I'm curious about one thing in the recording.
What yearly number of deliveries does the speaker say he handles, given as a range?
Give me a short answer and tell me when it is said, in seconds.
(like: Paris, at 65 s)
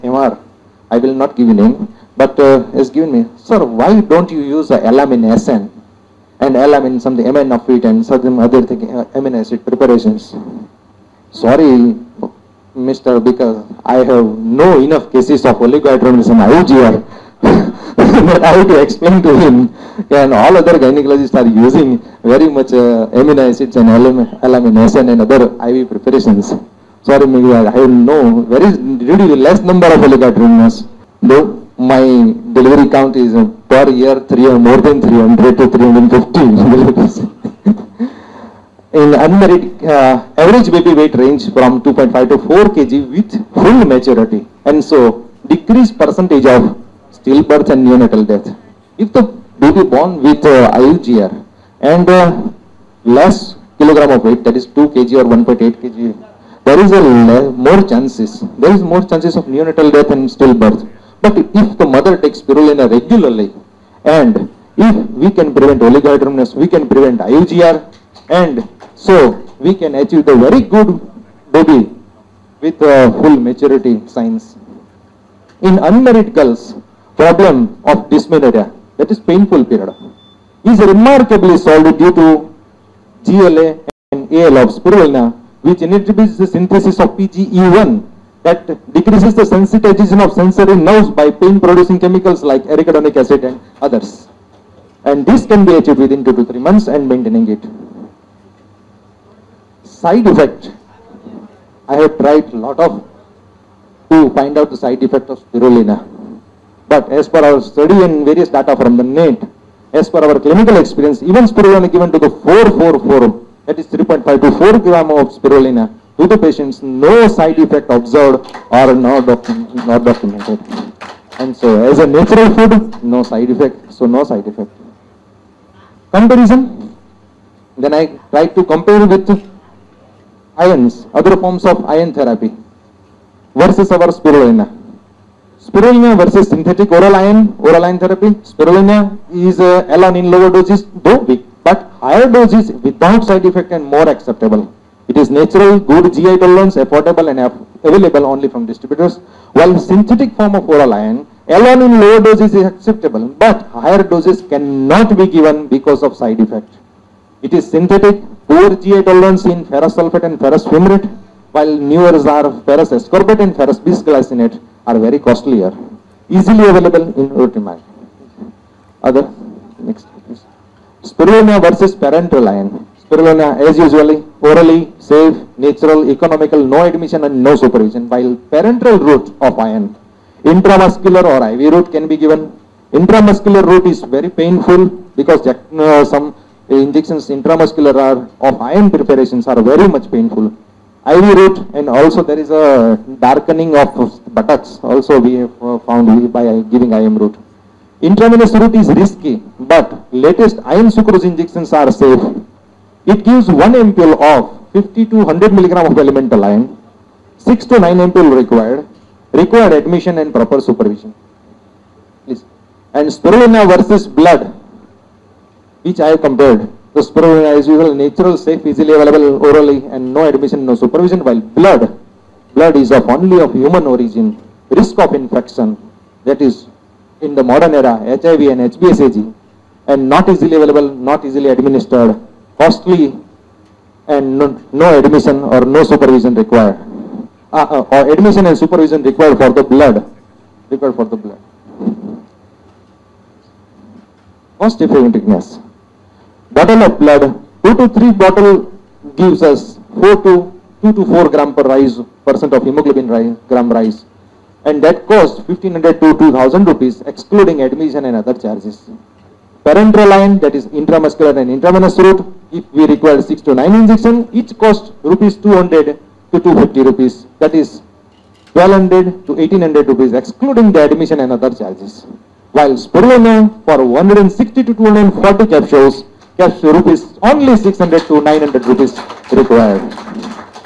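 300 to 350, at 34 s.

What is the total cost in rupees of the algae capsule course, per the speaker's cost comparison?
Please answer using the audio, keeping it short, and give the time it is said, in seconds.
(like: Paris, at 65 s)
600 to 900 rupees, at 277 s.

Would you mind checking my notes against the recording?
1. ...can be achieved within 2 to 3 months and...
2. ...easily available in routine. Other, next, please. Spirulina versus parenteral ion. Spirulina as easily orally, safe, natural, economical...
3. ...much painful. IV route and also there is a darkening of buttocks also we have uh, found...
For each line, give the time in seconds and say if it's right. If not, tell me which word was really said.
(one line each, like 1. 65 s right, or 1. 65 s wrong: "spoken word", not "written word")
1. 95 s right
2. 166 s wrong: "usually", not "easily"
3. 189 s right.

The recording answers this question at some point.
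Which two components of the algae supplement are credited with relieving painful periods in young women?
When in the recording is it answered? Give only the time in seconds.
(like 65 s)
83 s.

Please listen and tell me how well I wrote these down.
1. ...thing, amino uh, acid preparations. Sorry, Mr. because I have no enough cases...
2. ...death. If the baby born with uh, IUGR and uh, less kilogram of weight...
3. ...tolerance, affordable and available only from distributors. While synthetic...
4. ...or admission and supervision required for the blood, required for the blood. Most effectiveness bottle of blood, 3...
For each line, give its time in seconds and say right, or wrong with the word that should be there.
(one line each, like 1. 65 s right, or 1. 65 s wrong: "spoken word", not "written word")
1. 8 s right
2. 48 s right
3. 146 s right
4. 237 s wrong: "2", not "3".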